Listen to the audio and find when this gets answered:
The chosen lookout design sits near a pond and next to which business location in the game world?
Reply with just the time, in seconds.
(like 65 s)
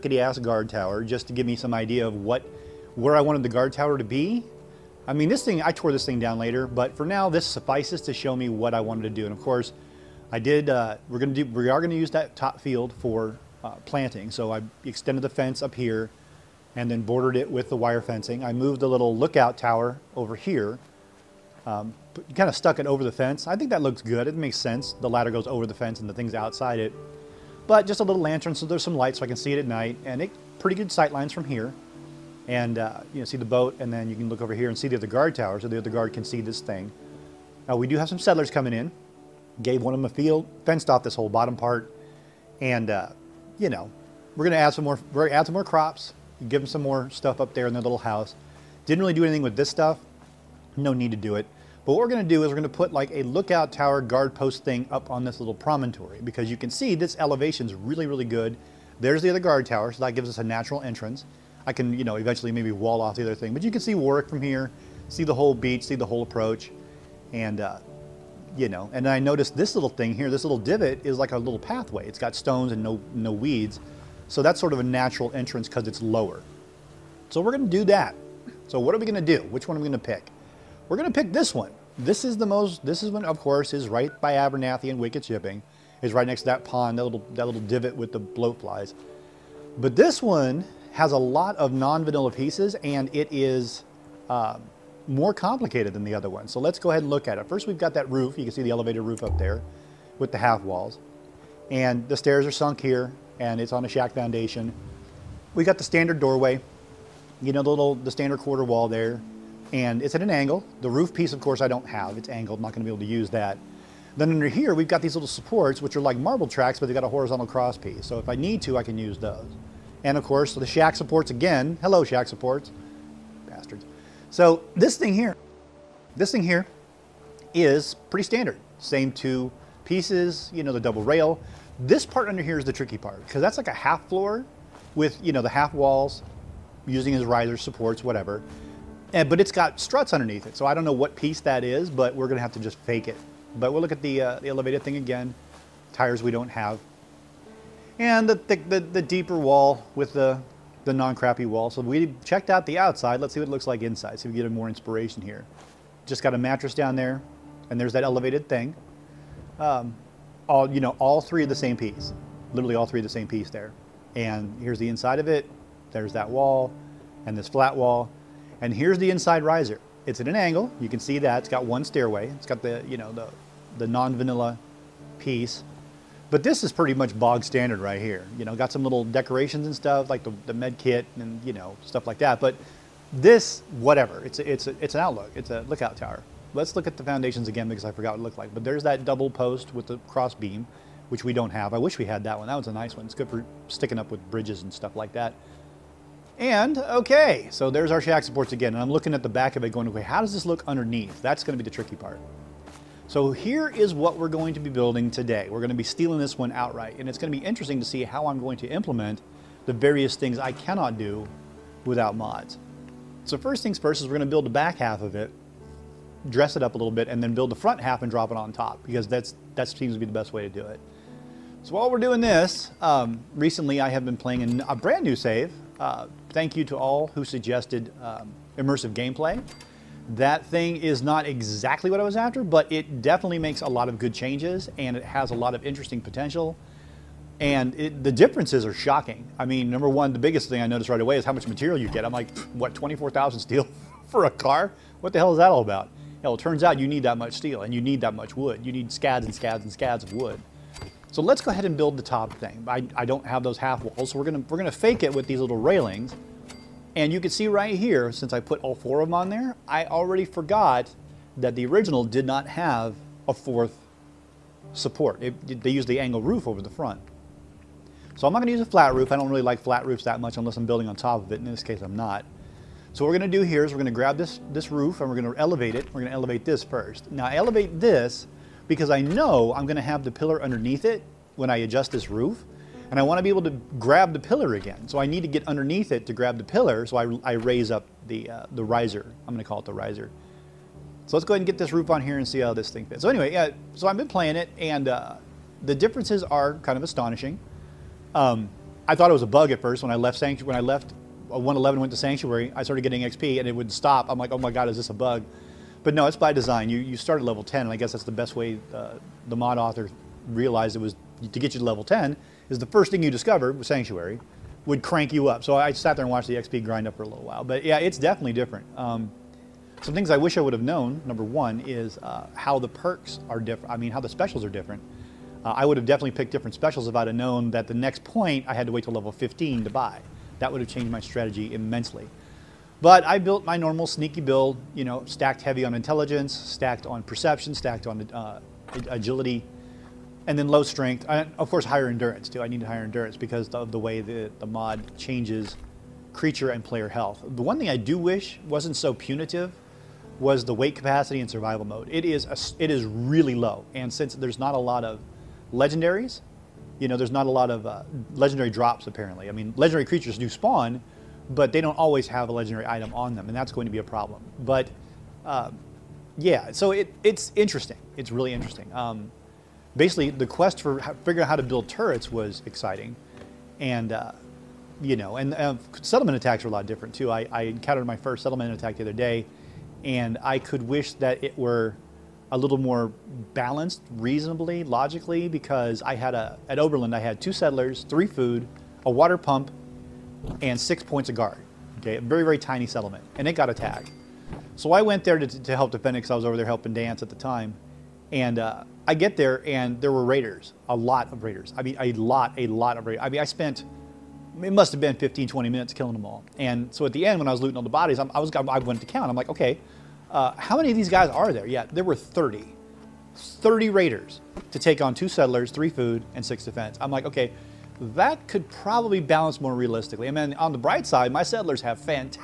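84 s.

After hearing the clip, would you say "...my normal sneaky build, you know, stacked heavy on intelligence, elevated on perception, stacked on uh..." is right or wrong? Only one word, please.
wrong.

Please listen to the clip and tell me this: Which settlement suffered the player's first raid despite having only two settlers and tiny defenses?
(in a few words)
Oberland.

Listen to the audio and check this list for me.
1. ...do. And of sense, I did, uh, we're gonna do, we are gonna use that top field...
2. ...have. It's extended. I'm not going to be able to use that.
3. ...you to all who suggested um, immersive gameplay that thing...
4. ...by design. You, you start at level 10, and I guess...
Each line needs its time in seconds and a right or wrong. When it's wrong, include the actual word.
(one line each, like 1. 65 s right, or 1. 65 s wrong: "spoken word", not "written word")
1. 9 s wrong: "course", not "sense"
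2. 111 s wrong: "angled", not "extended"
3. 226 s right
4. 306 s right.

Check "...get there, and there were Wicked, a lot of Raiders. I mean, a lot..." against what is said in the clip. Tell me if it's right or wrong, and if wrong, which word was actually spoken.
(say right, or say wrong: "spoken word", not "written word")
wrong: "Raiders", not "Wicked".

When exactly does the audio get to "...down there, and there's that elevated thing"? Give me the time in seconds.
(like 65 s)
156 s.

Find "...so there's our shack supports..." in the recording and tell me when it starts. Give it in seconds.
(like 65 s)
197 s.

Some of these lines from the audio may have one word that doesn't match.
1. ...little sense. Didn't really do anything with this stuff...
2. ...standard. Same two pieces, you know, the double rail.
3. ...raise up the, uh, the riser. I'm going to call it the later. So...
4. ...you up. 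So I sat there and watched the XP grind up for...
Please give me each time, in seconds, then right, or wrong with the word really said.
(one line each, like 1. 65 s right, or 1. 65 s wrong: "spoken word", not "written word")
1. 47 s wrong: "house", not "sense"
2. 128 s right
3. 287 s wrong: "riser", not "later"
4. 315 s right.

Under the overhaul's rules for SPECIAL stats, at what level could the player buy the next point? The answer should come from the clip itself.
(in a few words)
15.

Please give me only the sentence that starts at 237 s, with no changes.
And it, the differences are shocking.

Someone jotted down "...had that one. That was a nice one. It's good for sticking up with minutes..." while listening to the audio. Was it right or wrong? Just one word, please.
wrong.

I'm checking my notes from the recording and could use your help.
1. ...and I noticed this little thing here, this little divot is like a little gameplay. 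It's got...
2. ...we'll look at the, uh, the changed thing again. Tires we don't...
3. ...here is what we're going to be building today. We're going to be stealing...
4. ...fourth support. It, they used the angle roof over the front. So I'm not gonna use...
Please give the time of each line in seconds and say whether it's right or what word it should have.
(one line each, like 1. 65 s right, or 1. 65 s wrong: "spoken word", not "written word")
1. 68 s wrong: "pathway", not "gameplay"
2. 143 s wrong: "elevated", not "changed"
3. 203 s right
4. 263 s right.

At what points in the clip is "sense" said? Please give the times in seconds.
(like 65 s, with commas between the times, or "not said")
24 s.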